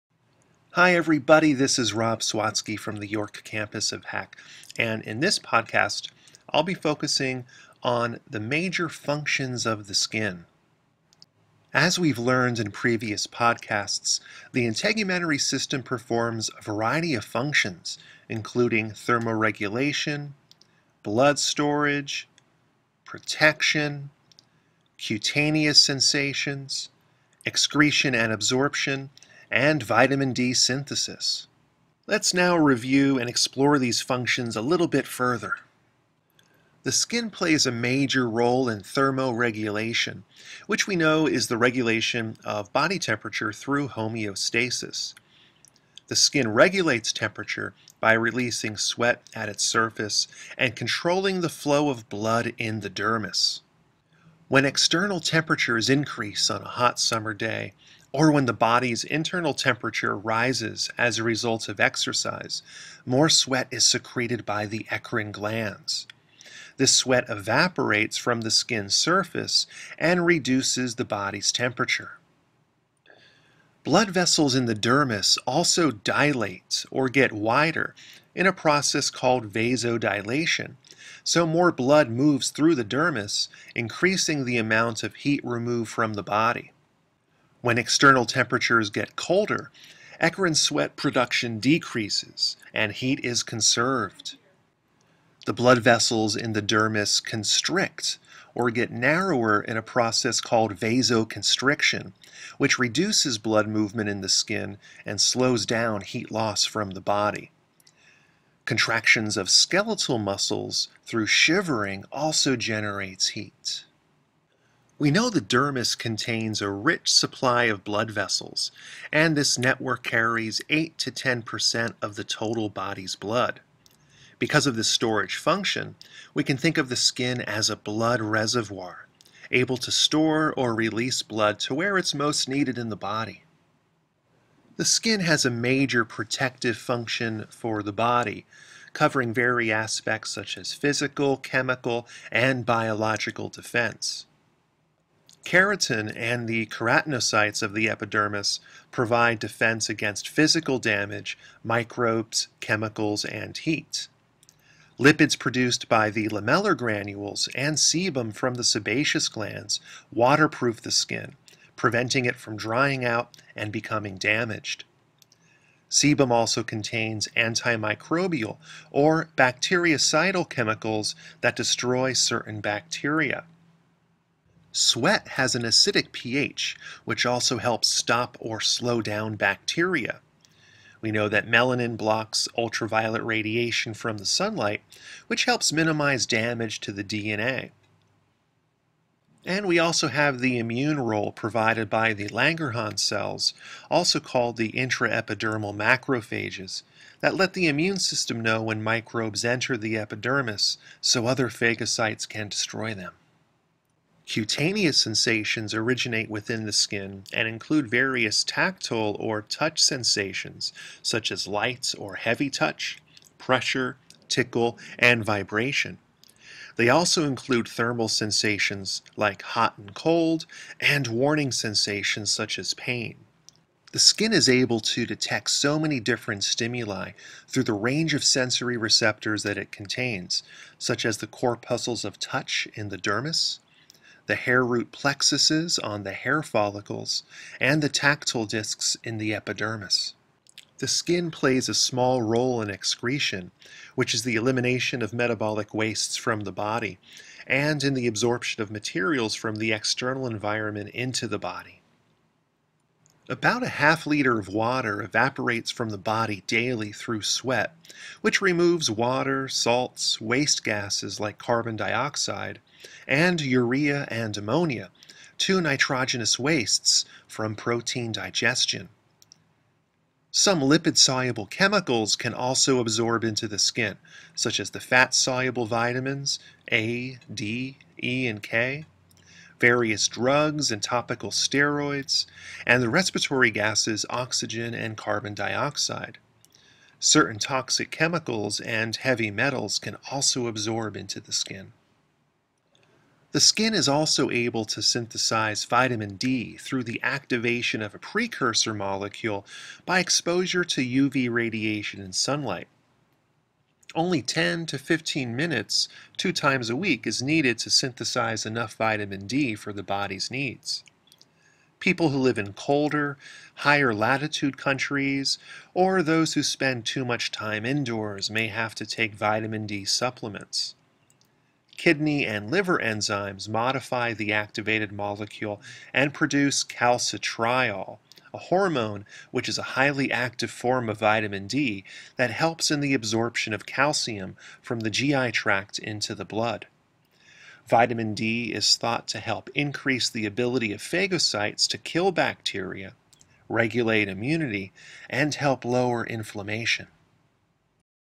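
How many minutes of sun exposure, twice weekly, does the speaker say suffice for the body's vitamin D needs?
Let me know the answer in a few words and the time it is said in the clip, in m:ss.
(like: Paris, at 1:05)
10 to 15, at 5:04.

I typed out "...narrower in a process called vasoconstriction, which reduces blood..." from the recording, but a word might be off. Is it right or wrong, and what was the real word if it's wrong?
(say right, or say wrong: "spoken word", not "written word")
right.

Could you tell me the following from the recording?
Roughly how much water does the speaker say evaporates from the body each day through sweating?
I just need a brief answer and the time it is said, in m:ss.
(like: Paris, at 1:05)
half liter, at 4:13.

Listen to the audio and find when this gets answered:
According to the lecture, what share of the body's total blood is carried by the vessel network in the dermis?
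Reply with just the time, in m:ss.
2:00.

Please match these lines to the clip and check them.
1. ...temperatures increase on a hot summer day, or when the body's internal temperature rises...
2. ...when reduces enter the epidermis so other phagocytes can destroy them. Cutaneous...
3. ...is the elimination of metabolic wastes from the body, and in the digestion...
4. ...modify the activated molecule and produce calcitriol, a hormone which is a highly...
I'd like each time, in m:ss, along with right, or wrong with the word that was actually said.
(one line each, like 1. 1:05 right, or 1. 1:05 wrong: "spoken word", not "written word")
1. 0:55 right
2. 3:18 wrong: "microbes", not "reduces"
3. 4:04 wrong: "absorption", not "digestion"
4. 5:23 right.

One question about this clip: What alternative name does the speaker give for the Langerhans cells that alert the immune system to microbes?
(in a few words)
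intraepidermal macrophages.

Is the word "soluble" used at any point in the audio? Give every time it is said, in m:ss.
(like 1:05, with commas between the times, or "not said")
4:30, 4:34.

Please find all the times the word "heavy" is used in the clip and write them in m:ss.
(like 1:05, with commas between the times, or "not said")
3:32, 4:48.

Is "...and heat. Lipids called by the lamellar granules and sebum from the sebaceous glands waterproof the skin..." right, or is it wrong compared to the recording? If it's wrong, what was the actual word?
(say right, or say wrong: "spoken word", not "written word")
wrong: "produced", not "called".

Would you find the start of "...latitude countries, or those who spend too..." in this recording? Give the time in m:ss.
5:13.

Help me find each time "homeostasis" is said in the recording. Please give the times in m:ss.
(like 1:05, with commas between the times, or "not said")
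0:43.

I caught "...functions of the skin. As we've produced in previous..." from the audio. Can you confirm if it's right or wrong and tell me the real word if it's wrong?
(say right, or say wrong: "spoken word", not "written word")
wrong: "learned", not "produced".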